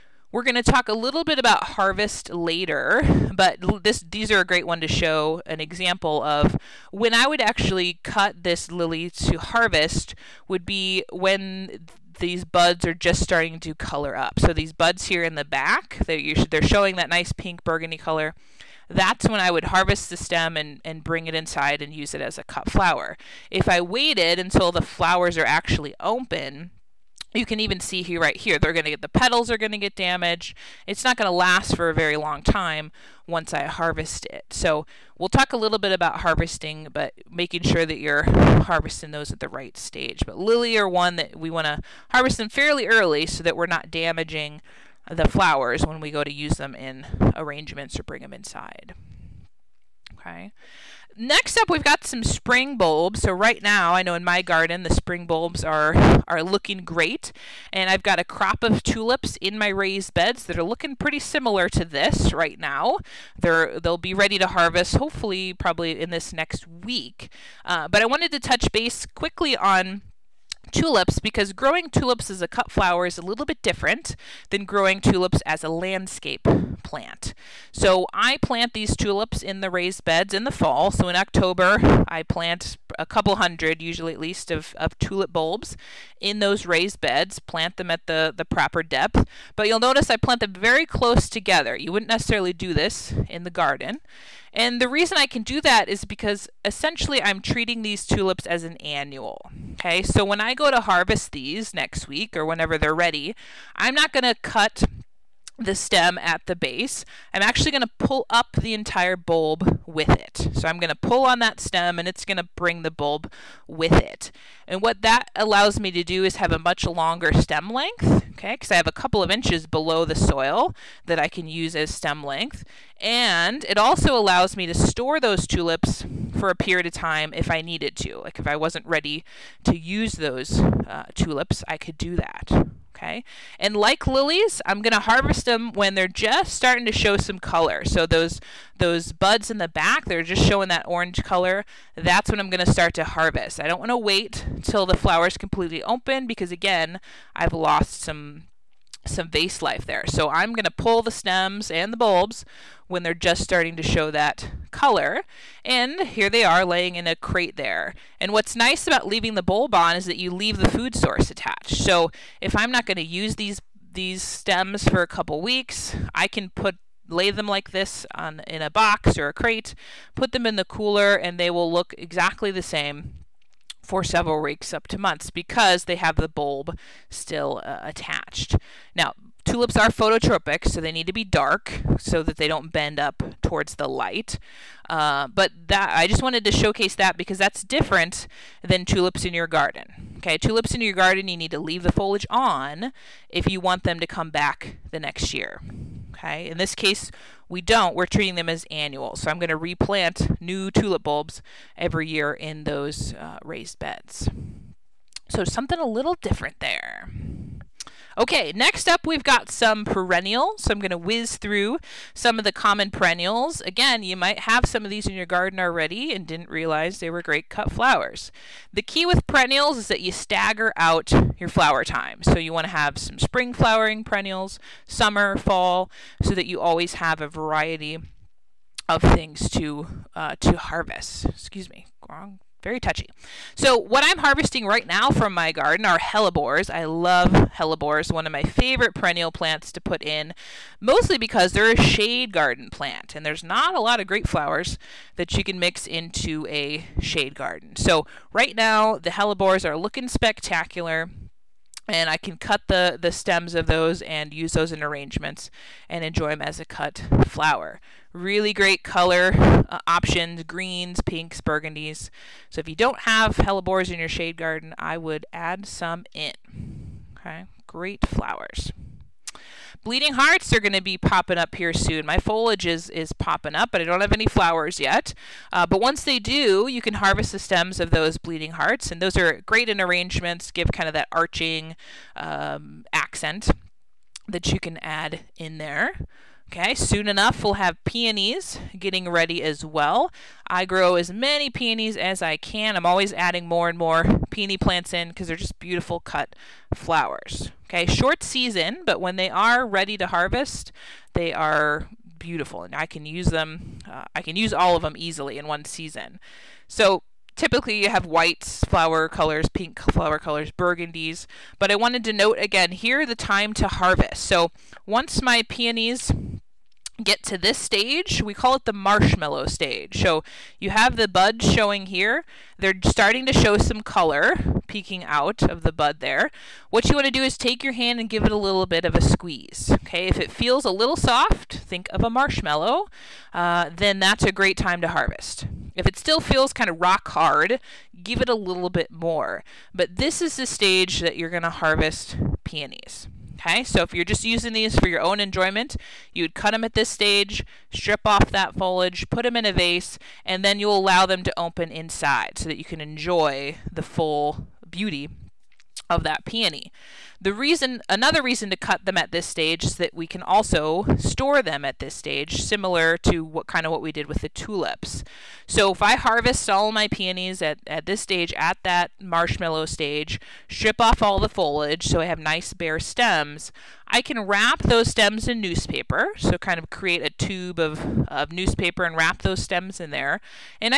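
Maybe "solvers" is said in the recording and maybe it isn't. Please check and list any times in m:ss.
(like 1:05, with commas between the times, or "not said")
not said.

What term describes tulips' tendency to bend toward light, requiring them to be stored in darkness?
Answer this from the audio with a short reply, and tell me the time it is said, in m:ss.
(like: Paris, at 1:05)
phototropic, at 2:59.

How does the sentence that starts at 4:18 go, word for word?
Really great color uh, options, greens, pinks, burgundies.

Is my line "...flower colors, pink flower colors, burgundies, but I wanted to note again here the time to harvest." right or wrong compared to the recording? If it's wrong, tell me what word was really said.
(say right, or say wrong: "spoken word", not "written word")
right.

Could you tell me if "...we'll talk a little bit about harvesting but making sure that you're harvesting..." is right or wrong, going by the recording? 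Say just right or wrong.
right.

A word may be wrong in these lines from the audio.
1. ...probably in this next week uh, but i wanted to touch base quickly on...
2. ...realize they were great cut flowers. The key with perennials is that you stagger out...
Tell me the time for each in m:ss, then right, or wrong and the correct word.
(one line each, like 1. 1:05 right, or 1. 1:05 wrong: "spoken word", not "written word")
1. 1:05 right
2. 3:36 right.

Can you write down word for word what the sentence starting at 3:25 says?
So something a little different there.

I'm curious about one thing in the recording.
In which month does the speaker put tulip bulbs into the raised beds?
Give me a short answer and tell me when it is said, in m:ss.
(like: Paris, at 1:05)
October, at 1:21.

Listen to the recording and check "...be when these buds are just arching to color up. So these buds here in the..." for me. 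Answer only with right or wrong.
wrong.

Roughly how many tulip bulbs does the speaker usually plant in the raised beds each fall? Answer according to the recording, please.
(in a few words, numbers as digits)
a couple hundred.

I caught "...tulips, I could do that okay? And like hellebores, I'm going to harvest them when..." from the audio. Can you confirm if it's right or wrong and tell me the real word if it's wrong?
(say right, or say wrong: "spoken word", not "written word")
wrong: "lilies", not "hellebores".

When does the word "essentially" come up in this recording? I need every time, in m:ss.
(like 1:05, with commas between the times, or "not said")
1:36.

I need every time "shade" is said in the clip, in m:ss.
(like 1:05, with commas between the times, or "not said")
4:01, 4:06, 4:24.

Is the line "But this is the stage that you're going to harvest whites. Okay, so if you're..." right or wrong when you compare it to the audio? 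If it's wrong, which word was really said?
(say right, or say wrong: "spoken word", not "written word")
wrong: "peonies", not "whites".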